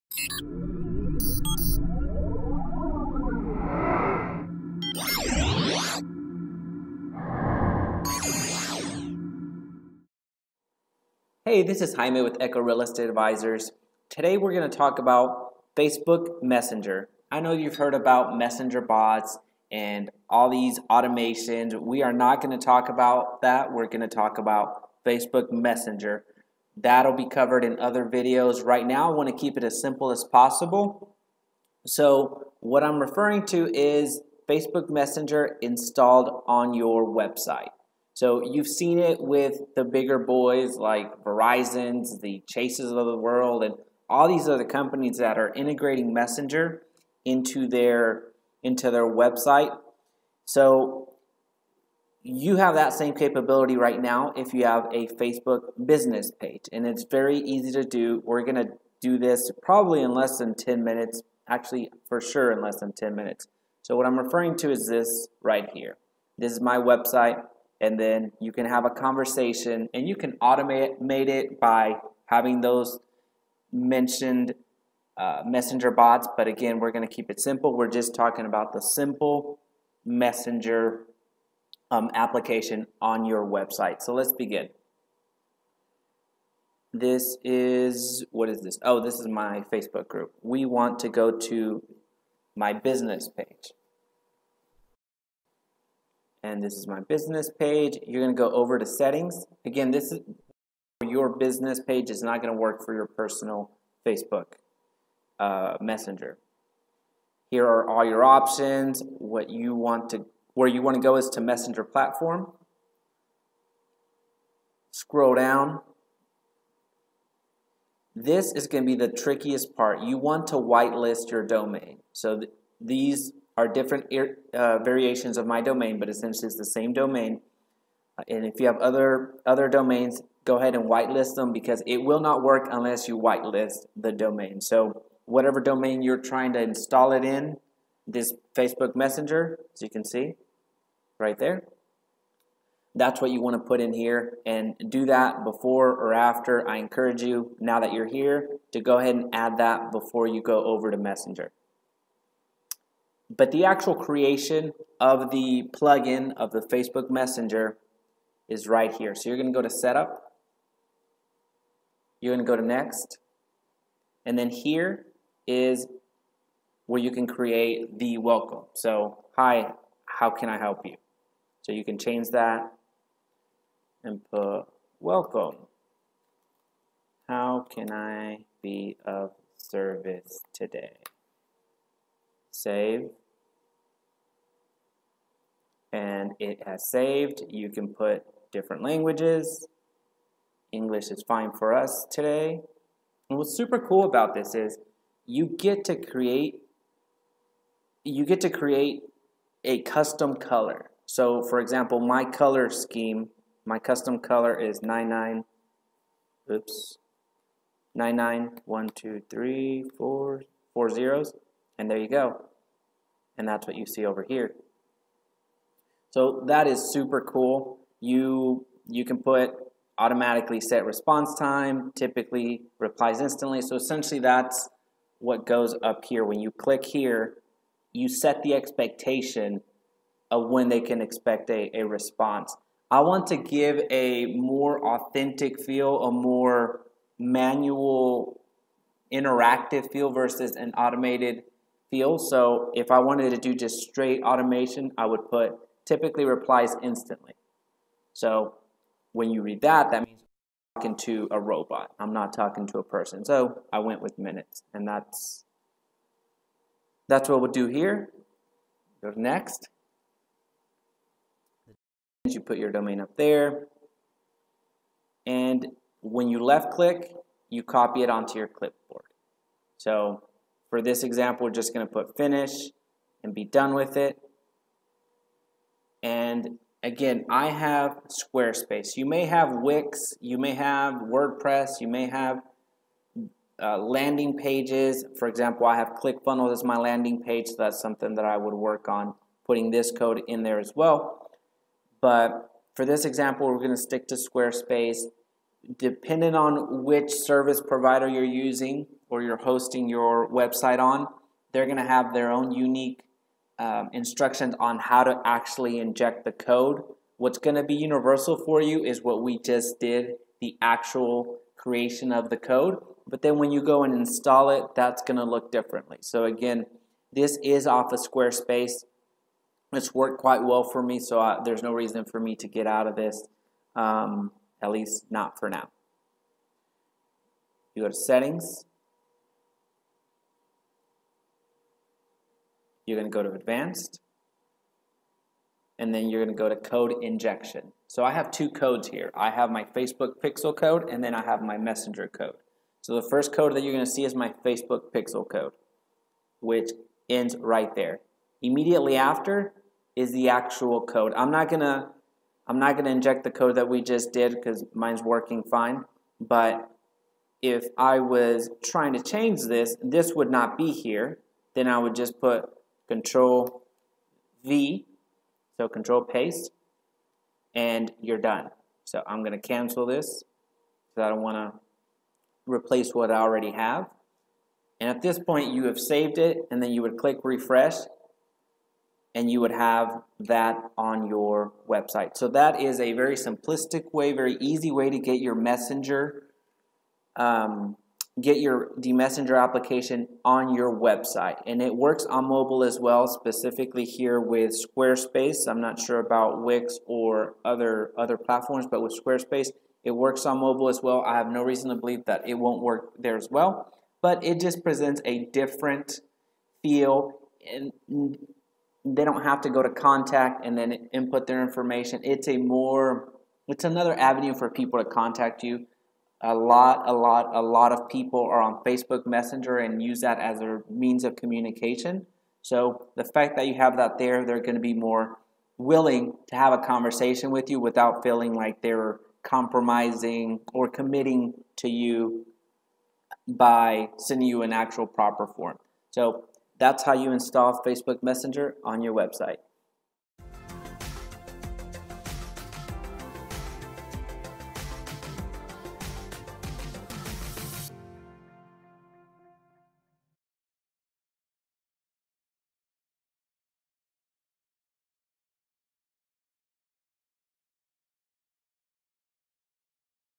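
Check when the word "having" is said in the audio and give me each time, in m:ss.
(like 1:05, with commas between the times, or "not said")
1:12.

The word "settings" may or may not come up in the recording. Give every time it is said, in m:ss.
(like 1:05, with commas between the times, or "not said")
1:38, 5:27.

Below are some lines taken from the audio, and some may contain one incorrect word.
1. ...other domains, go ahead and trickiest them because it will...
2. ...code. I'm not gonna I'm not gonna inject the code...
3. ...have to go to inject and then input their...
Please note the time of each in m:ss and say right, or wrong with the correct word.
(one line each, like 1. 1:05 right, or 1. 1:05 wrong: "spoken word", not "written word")
1. 2:09 wrong: "whitelist", not "trickiest"
2. 5:50 right
3. 6:49 wrong: "contact", not "inject".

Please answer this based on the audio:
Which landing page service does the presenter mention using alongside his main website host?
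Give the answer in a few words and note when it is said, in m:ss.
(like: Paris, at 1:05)
ClickFunnels, at 4:46.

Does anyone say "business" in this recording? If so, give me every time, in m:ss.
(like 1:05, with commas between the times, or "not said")
0:55, 1:32, 1:37, 1:41.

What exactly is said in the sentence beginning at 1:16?
But again, we're going to keep it simple.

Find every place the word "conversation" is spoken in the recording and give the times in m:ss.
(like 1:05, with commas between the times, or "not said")
1:08, 7:06.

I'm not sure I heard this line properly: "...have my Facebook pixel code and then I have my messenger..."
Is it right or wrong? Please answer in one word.
right.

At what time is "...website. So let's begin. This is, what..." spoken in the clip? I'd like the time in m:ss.
1:23.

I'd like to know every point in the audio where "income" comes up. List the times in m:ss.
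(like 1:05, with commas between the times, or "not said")
not said.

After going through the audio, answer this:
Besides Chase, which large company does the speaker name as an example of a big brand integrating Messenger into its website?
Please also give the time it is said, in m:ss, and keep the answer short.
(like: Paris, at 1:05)
Verizon, at 0:41.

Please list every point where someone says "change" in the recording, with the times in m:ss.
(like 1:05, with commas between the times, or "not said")
2:51, 5:59.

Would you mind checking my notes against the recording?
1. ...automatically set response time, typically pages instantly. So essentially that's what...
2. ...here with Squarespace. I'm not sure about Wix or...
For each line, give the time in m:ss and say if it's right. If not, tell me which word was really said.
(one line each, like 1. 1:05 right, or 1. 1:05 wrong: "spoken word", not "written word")
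1. 3:39 wrong: "replies", not "pages"
2. 6:33 right.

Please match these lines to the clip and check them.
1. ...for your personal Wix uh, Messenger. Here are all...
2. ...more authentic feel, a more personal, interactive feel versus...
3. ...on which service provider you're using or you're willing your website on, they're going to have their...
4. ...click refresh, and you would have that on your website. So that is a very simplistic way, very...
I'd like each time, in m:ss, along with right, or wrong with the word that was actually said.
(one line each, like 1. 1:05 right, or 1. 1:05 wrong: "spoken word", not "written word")
1. 1:42 wrong: "Facebook", not "Wix"
2. 3:54 wrong: "manual", not "personal"
3. 4:56 wrong: "hosting", not "willing"
4. 6:16 right.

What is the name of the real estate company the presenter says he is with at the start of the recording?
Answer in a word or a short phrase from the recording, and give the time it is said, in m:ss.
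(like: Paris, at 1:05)
Echo Real Estate Advisors, at 0:12.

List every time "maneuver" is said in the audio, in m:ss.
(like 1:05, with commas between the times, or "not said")
not said.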